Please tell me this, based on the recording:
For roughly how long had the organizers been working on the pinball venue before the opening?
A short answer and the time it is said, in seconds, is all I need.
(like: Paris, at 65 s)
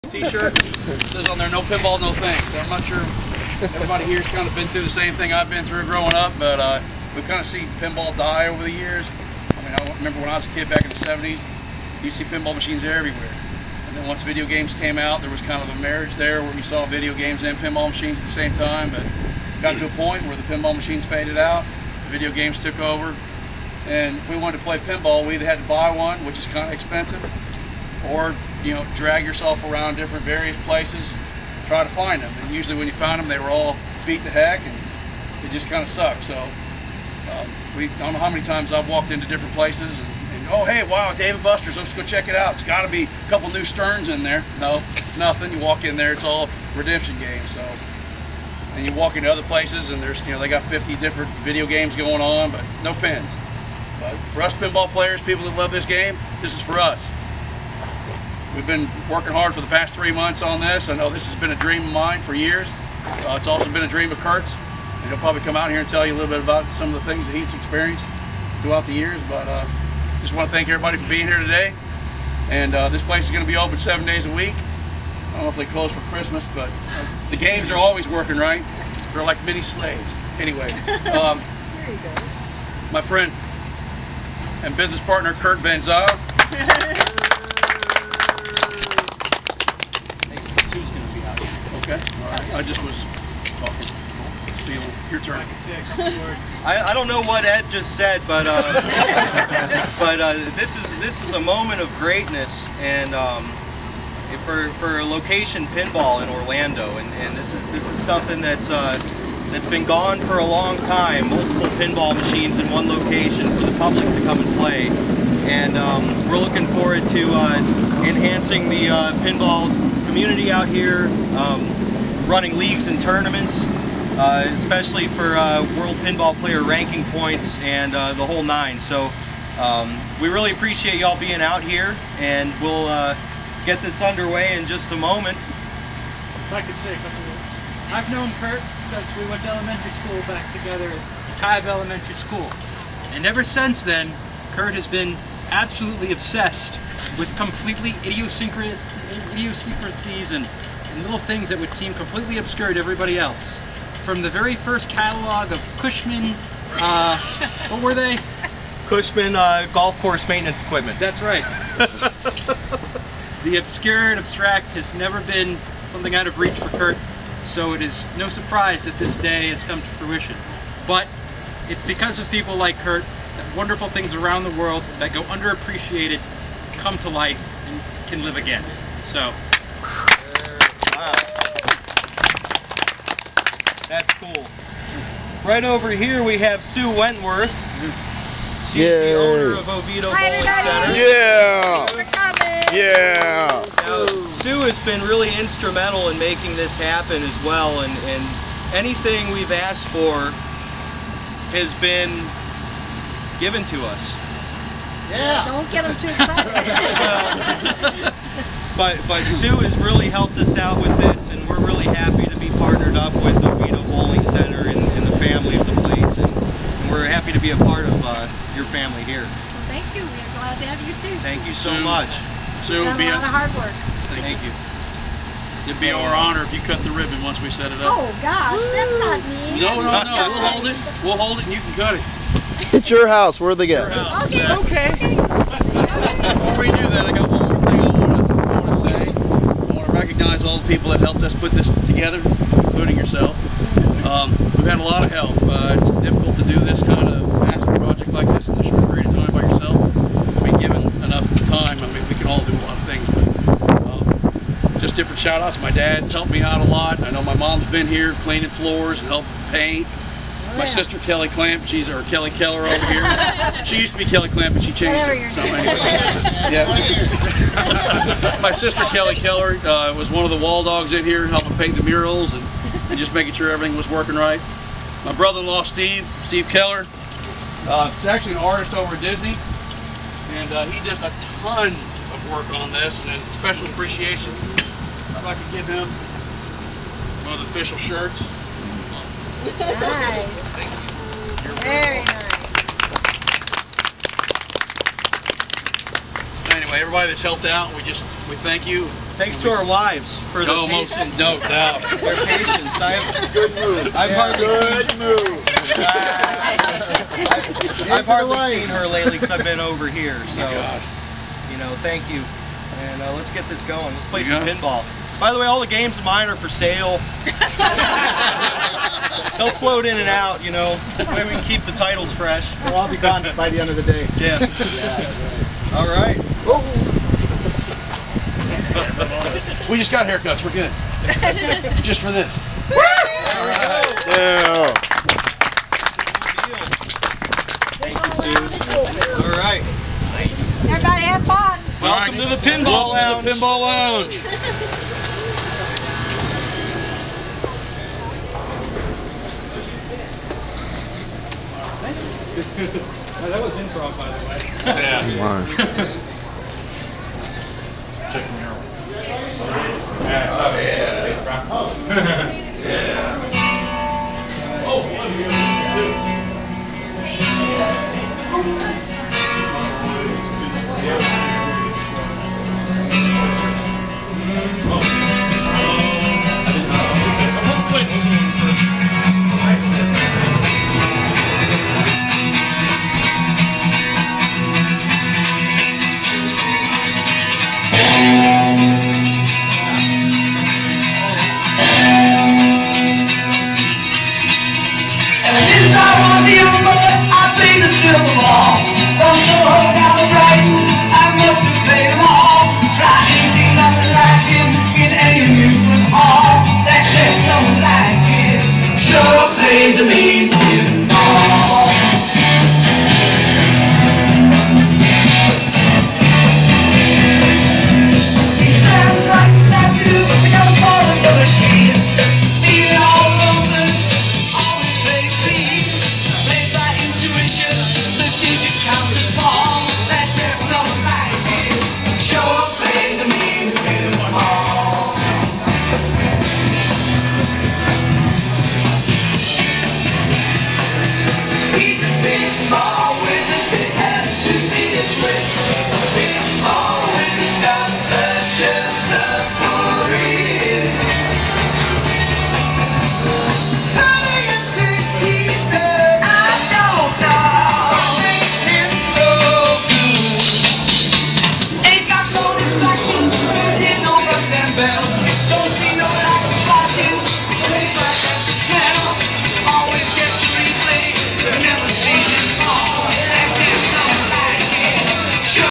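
3 months, at 59 s.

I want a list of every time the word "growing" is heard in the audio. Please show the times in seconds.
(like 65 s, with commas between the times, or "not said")
5 s.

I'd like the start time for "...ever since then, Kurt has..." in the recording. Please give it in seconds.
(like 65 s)
143 s.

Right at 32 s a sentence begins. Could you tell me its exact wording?
And usually when you found them, they were all beat to heck and it just kind of sucked.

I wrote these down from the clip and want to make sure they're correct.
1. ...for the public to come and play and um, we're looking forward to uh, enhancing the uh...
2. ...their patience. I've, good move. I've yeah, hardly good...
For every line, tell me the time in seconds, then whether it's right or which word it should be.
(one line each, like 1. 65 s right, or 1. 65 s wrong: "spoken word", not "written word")
1. 113 s right
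2. 301 s right.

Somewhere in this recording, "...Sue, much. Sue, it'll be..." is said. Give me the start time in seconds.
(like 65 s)
221 s.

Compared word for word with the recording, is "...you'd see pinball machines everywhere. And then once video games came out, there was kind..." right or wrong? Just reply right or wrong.
right.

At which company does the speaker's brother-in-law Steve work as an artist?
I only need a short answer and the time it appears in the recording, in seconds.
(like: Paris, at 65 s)
Disney, at 279 s.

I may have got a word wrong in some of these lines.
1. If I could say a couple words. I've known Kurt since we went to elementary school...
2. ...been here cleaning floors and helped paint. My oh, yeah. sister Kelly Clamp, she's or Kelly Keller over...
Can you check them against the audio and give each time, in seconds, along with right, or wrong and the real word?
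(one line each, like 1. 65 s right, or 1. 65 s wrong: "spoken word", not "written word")
1. 135 s right
2. 257 s right.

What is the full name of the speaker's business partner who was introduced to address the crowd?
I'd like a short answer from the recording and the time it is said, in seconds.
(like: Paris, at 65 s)
Kurt Van Zyl, at 85 s.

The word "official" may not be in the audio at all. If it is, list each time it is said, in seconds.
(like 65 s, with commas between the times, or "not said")
287 s.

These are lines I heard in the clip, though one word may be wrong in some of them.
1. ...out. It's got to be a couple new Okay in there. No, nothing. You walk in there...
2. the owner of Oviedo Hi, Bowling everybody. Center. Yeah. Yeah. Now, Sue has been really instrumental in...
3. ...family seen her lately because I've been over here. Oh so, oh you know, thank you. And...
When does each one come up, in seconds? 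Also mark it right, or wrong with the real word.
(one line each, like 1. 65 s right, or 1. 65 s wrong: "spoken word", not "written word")
1. 42 s wrong: "Sterns", not "Okay"
2. 188 s right
3. 308 s wrong: "hardly", not "family".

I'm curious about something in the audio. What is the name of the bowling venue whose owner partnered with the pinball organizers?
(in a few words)
Oviedo Bowling Center.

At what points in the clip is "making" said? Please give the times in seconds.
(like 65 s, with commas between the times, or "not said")
196 s, 273 s.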